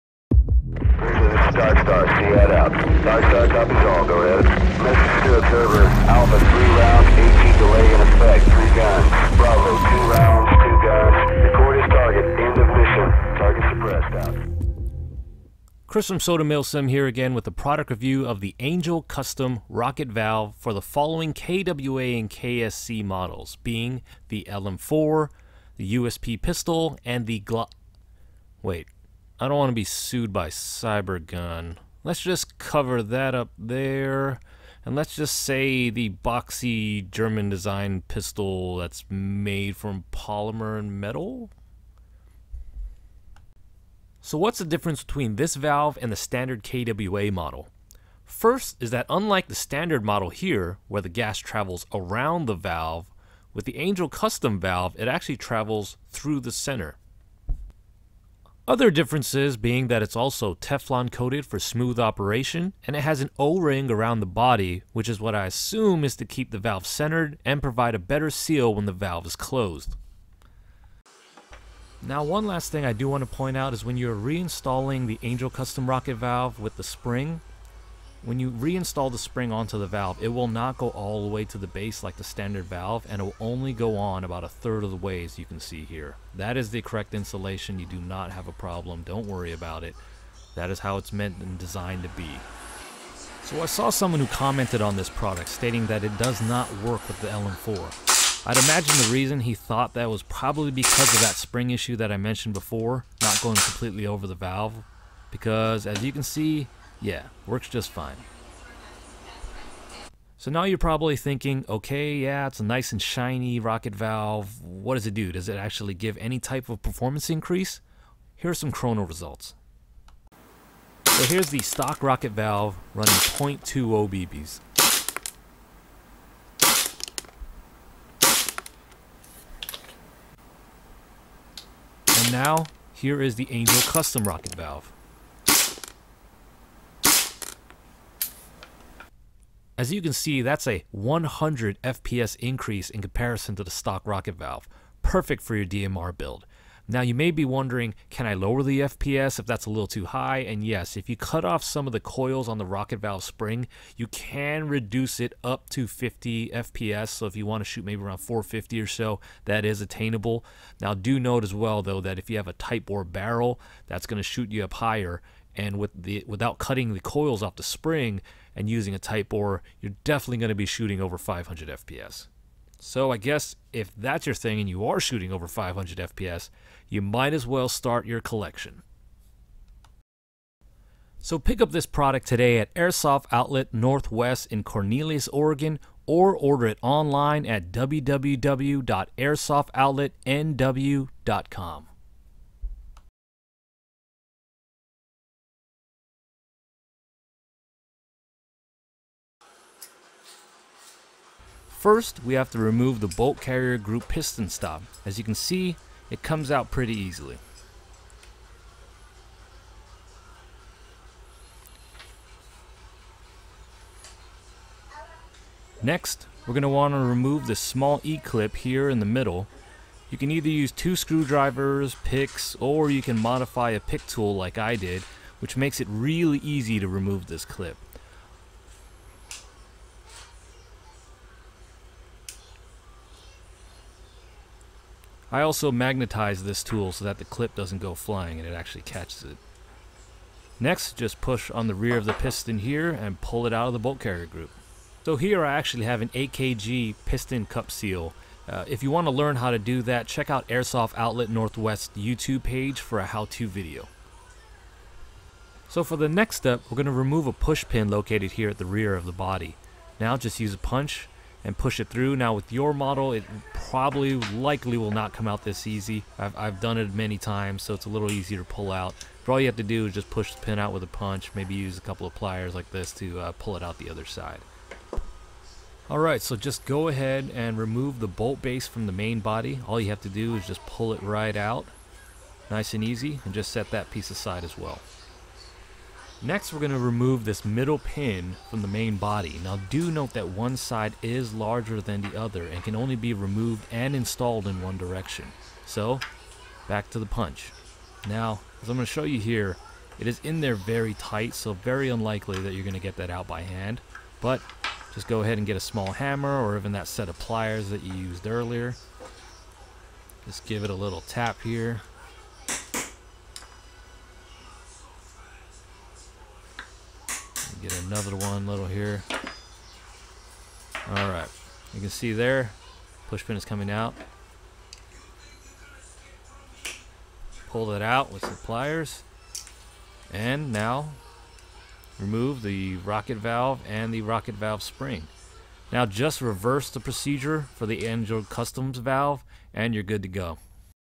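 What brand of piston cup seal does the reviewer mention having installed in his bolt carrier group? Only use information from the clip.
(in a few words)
AKG.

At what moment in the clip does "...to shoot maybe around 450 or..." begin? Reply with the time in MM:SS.
02:37.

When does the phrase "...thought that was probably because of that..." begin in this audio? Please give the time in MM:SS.
01:39.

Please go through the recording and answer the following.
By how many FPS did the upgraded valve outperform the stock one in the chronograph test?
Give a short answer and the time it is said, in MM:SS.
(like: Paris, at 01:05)
100 FPS, at 02:20.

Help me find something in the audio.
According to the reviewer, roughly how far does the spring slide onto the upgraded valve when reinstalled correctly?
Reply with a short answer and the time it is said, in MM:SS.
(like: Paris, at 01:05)
a third of the way, at 01:24.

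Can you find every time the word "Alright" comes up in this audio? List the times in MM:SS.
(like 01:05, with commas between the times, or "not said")
04:35.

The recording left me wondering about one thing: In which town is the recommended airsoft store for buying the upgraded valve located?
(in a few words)
Cornelius.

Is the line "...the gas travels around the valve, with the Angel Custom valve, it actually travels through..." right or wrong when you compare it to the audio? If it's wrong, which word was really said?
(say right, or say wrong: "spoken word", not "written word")
right.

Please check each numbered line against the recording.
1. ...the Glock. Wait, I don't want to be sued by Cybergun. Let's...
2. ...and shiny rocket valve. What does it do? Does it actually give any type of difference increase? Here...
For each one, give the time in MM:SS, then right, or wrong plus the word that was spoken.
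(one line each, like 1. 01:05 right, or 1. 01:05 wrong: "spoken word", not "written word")
1. 00:27 right
2. 01:52 wrong: "performance", not "difference".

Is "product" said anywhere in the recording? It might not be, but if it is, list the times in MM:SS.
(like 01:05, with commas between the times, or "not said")
00:17, 01:35, 03:01.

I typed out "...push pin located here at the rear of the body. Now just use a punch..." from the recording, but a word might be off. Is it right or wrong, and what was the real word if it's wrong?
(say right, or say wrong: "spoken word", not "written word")
right.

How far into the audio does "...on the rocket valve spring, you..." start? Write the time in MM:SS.
02:32.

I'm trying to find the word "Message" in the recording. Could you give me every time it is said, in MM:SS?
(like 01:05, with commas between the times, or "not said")
00:04.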